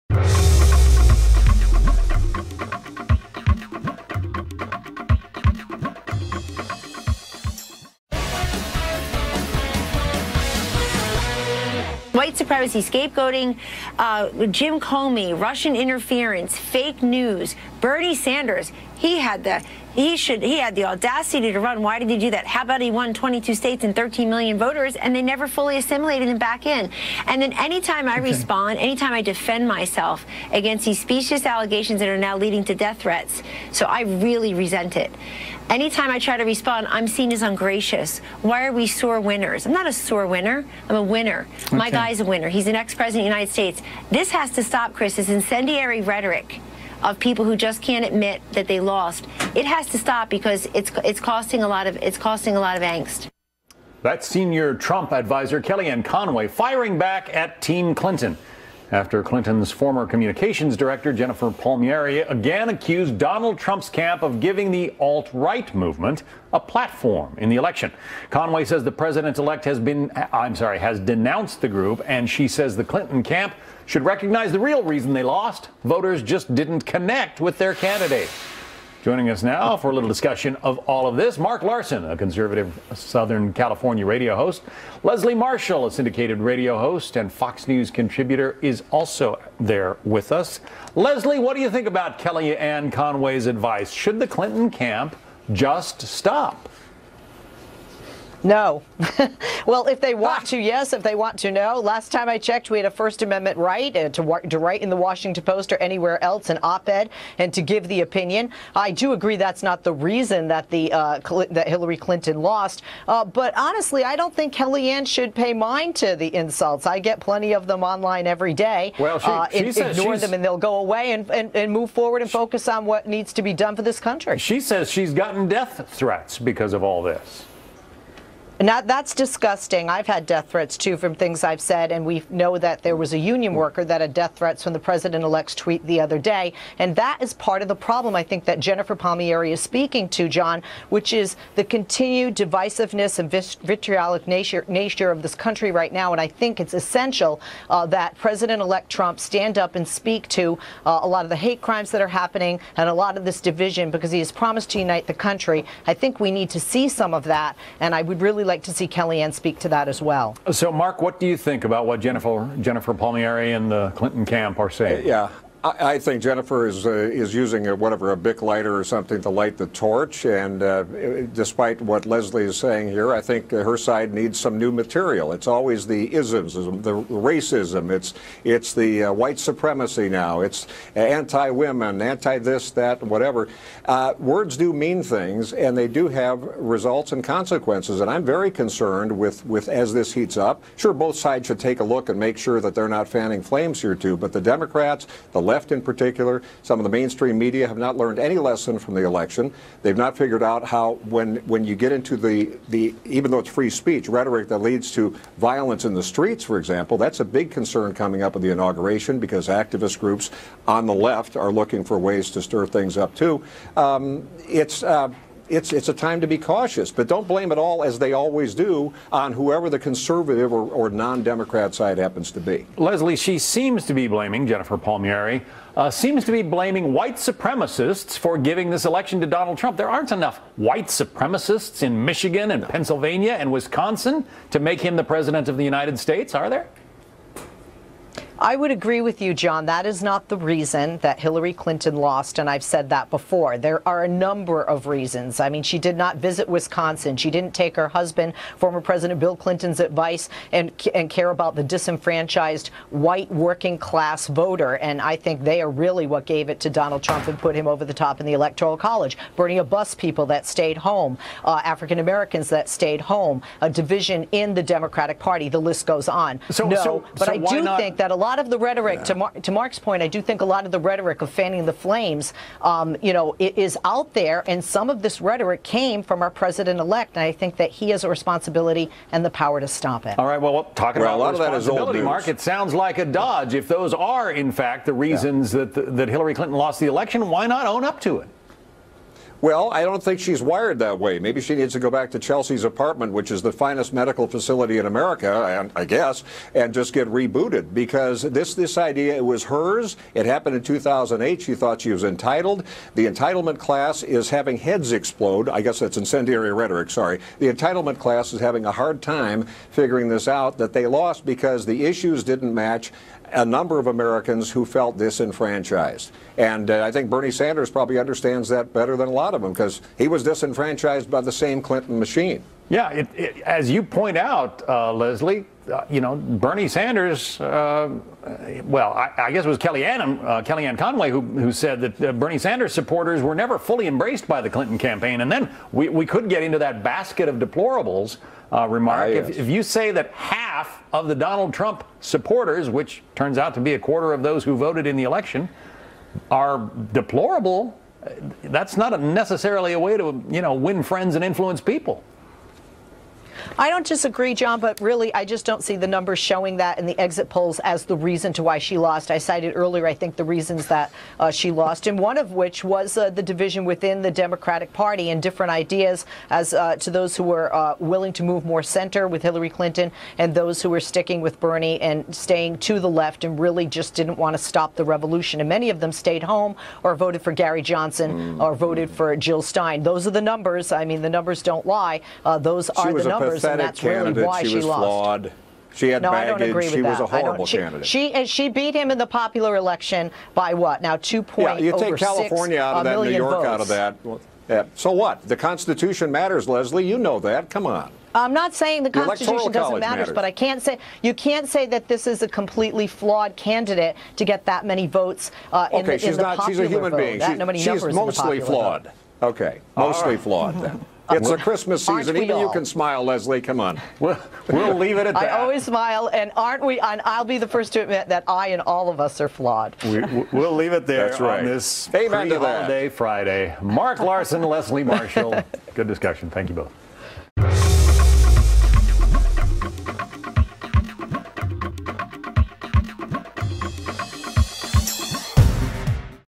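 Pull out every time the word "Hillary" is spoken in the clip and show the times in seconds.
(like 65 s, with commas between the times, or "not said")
111 s, 241 s, 286 s, 369 s.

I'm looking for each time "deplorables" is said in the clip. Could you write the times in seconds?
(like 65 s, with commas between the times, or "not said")
337 s, 346 s.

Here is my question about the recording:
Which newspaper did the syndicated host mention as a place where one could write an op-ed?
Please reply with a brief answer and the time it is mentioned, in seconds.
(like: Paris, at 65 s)
Washington Post, at 104 s.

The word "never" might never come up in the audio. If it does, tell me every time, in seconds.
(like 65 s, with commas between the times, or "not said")
25 s, 333 s.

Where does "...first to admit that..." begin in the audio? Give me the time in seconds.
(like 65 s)
417 s.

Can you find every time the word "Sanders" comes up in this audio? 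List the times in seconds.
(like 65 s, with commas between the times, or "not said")
18 s, 317 s, 326 s, 332 s.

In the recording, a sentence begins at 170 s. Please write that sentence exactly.
And uh, despite what Leslie is saying here, I think her side needs some new material.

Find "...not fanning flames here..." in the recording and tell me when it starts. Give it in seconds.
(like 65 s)
192 s.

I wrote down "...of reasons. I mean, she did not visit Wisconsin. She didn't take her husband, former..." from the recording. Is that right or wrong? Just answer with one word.
right.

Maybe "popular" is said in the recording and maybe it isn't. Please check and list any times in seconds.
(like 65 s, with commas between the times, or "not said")
389 s, 406 s.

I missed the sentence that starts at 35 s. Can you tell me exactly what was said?
Anytime I try to respond, I'm seen as ungracious.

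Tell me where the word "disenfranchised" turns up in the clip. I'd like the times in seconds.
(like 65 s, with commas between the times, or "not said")
251 s, 314 s, 320 s.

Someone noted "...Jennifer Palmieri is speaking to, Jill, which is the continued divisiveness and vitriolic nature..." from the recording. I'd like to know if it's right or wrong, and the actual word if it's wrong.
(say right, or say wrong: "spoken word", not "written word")
wrong: "John", not "Jill".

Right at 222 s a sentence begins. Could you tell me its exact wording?
Leslie, she seems to be blaming Jennifer Palmieri, uh, seems to be blaming white supremacists for giving this election to Donald Trump.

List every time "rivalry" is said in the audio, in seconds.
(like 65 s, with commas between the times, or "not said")
not said.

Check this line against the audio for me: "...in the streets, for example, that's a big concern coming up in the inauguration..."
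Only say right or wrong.
right.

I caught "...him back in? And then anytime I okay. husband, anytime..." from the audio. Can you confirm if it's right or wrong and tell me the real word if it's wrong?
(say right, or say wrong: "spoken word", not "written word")
wrong: "respond", not "husband".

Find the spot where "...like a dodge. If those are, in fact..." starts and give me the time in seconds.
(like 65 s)
282 s.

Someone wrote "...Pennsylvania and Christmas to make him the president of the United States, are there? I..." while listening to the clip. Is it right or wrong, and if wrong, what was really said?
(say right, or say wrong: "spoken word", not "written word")
wrong: "Wisconsin", not "Christmas".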